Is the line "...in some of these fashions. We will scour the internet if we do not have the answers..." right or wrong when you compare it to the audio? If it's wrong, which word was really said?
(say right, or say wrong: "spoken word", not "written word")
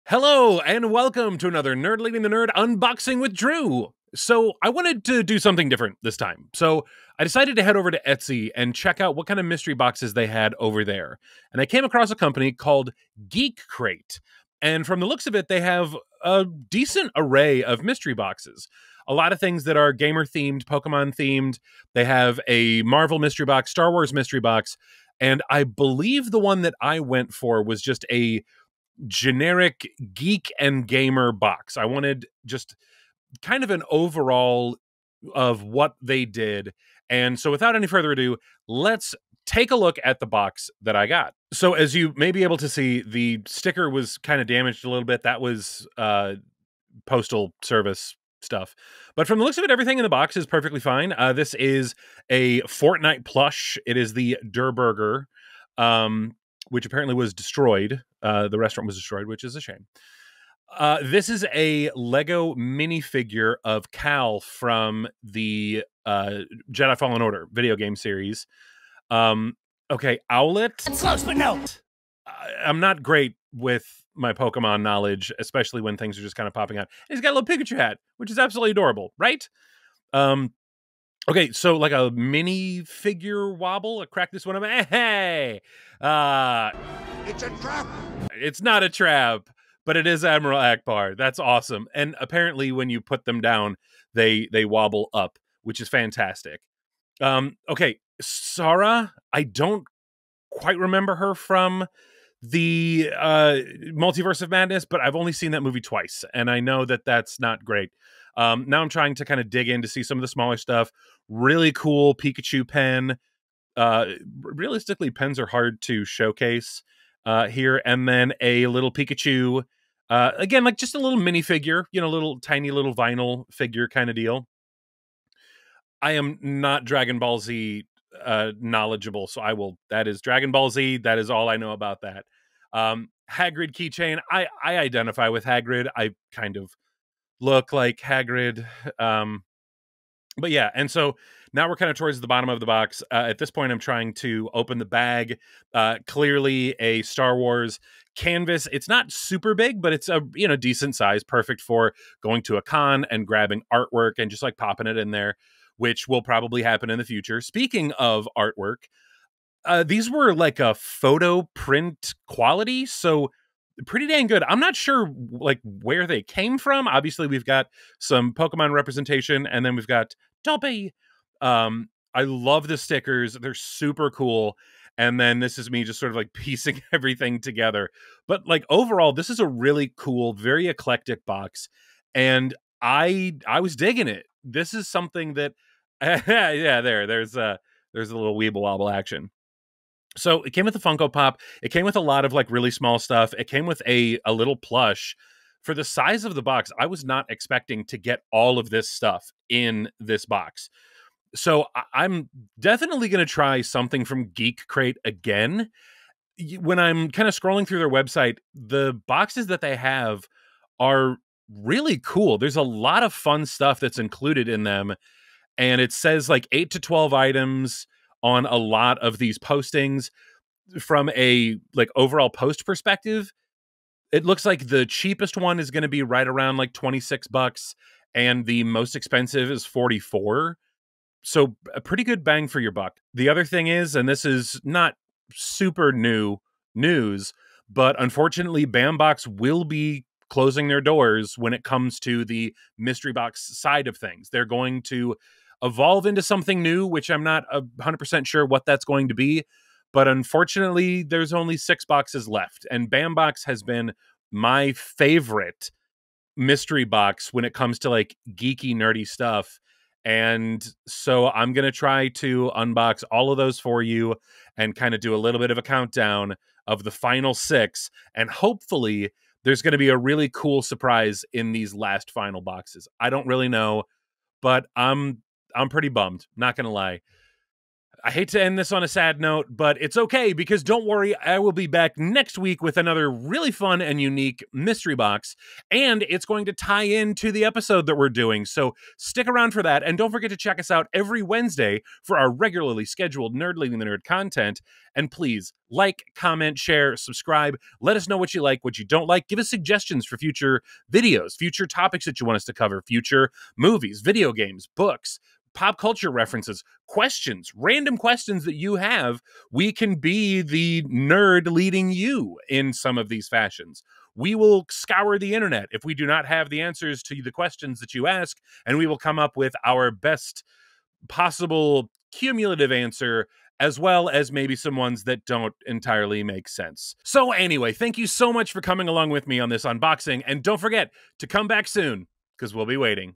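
right.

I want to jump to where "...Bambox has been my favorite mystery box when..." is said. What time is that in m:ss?
4:12.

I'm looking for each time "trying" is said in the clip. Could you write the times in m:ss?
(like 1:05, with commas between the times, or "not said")
1:48, 2:23.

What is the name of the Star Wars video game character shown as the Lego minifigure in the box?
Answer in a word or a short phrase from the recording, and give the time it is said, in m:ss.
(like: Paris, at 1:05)
Cal, at 1:03.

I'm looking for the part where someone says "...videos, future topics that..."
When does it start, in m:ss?
5:00.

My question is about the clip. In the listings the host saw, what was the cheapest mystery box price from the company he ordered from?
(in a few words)
$26.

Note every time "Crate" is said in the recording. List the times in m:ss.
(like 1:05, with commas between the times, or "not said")
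0:13, 3:24.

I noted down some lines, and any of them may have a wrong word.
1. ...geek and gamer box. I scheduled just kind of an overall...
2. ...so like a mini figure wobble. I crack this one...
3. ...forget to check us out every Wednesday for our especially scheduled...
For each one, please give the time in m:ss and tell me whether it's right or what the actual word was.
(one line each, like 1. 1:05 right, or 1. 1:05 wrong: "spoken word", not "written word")
1. 0:30 wrong: "wanted", not "scheduled"
2. 1:21 right
3. 4:50 wrong: "regularly", not "especially".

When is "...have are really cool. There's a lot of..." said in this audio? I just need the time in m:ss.
3:29.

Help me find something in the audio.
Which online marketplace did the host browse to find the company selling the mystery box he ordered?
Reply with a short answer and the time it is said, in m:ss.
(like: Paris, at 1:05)
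Etsy, at 0:08.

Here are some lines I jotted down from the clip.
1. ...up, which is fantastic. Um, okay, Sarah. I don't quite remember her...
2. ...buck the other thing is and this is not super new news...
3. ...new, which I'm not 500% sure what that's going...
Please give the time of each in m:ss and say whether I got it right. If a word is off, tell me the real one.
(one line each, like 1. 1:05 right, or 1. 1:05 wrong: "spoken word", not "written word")
1. 1:35 right
2. 3:52 right
3. 4:06 wrong: "100", not "500".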